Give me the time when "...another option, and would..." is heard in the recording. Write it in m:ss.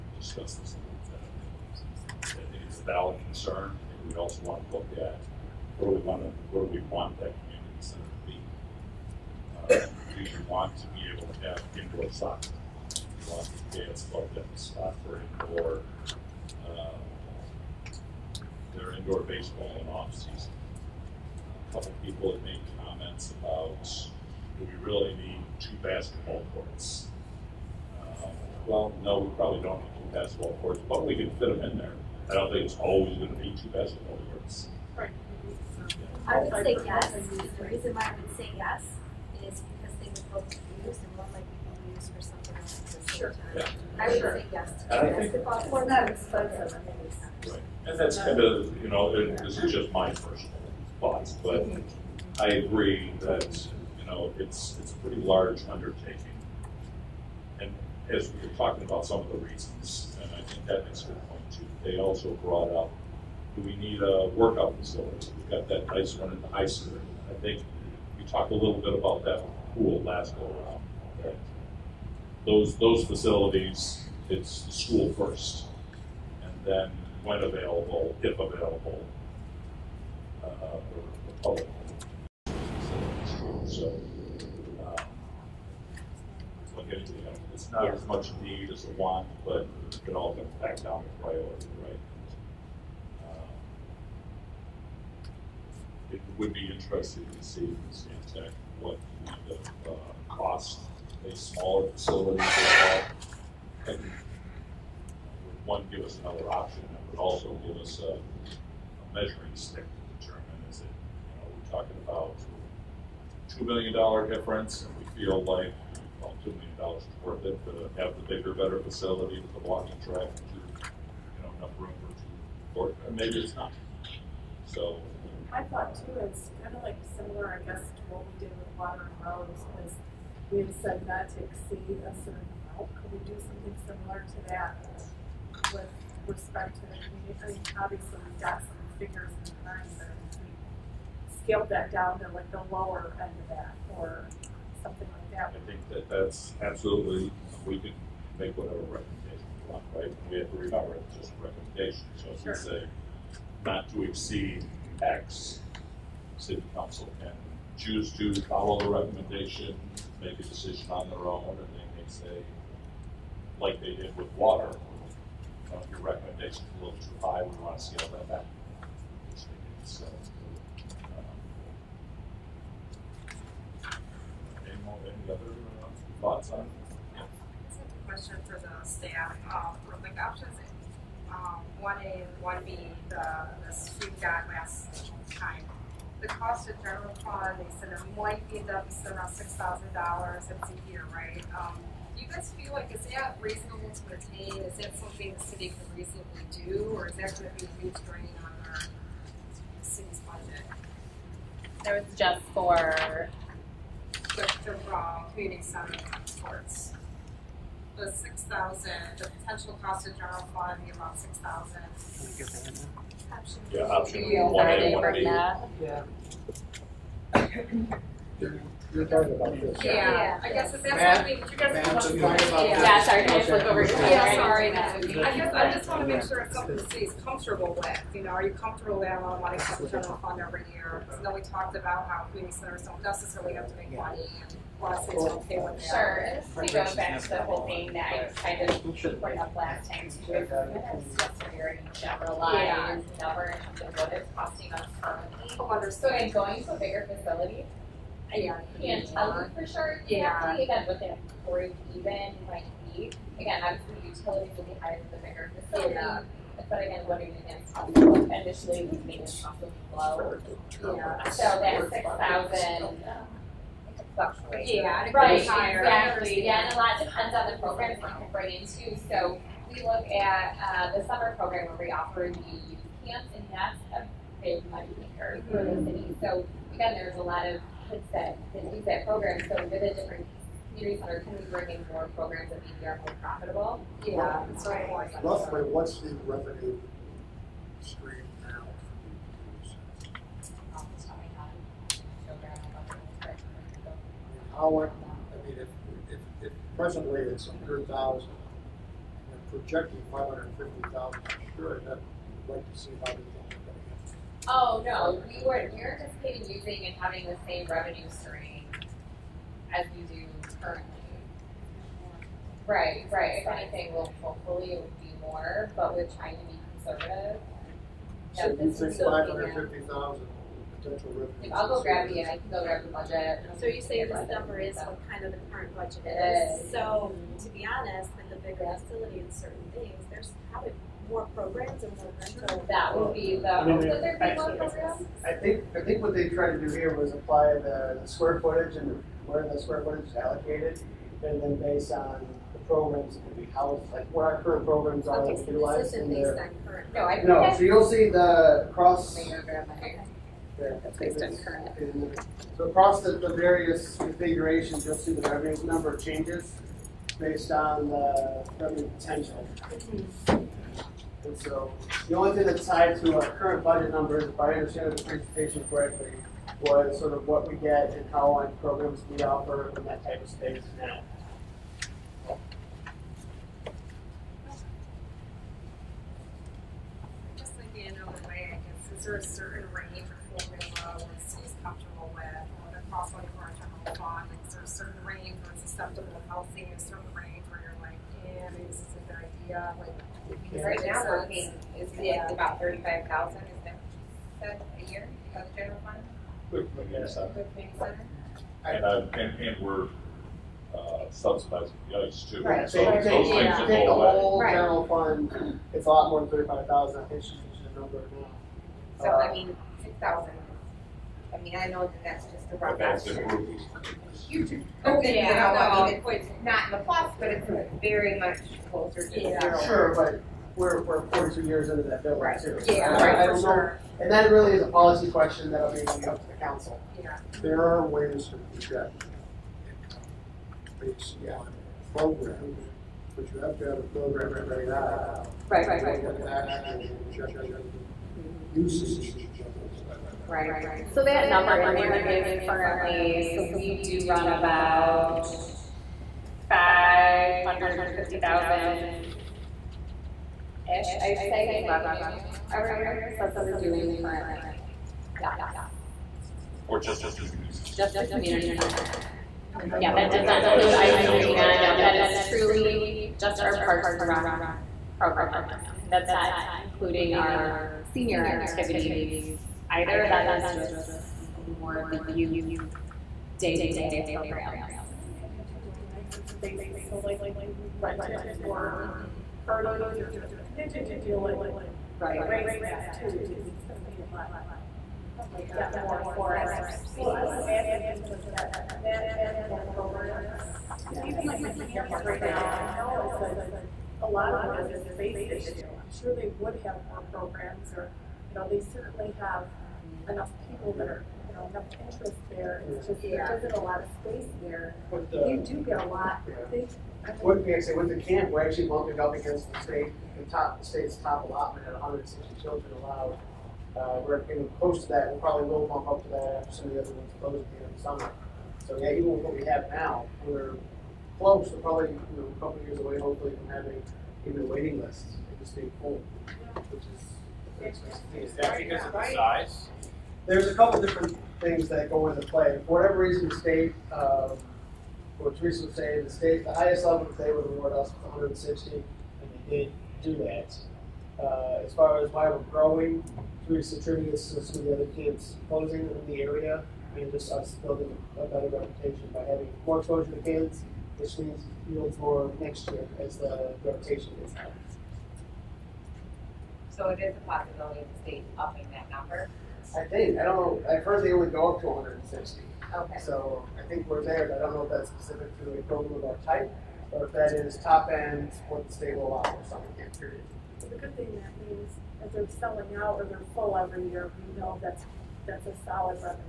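1:46.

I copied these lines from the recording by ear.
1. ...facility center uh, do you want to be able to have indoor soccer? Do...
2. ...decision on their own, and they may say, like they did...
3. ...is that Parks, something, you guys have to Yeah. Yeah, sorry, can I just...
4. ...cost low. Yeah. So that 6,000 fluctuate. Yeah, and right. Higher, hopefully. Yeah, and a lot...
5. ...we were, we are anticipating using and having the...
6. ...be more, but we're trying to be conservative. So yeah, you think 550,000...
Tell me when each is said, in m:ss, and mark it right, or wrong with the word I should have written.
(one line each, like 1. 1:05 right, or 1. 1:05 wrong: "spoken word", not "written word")
1. 0:07 wrong: "community", not "facility"
2. 2:40 right
3. 3:40 wrong: "Matt", not "Parks"
4. 4:19 wrong: "exactly", not "hopefully"
5. 5:05 right
6. 5:14 right.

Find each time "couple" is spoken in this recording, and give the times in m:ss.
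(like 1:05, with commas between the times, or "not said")
0:21, 8:42, 8:50.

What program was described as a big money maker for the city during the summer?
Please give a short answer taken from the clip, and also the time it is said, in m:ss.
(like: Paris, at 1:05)
youth camps, at 4:32.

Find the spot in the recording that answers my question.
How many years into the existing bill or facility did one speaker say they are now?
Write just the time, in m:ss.
7:01.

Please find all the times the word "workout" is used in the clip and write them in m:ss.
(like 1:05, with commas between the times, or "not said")
1:04.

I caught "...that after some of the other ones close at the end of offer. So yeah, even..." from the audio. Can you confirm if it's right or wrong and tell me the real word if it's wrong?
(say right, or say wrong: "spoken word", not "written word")
wrong: "summer", not "offer".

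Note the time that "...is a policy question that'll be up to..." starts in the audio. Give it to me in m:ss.
7:04.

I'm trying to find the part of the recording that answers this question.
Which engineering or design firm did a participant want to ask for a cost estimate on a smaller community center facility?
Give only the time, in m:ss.
1:37.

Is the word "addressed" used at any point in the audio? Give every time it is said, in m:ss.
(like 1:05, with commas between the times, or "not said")
not said.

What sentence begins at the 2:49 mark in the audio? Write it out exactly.
So, um, any, more, any other uh, thoughts on it?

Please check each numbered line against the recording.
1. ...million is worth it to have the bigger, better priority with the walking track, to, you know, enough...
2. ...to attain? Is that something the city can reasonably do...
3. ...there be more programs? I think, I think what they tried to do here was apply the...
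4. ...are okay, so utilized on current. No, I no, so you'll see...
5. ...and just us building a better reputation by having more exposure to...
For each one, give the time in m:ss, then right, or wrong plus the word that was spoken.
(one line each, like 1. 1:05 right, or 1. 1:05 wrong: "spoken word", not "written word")
1. 1:56 wrong: "facility", not "priority"
2. 3:13 right
3. 5:33 right
4. 5:45 right
5. 9:06 right.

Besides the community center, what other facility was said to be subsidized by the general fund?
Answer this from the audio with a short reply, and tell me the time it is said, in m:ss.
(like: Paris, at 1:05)
the ice, at 6:41.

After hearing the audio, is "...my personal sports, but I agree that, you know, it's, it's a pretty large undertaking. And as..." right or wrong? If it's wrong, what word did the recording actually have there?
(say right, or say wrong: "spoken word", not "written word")
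wrong: "thoughts", not "sports".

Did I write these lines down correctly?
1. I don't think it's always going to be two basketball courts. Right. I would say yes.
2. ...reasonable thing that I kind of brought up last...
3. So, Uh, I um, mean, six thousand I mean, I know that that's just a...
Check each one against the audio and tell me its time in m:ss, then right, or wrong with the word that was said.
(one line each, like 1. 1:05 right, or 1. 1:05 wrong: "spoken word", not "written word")
1. 0:32 right
2. 3:57 wrong: "whole", not "reasonable"
3. 6:49 right.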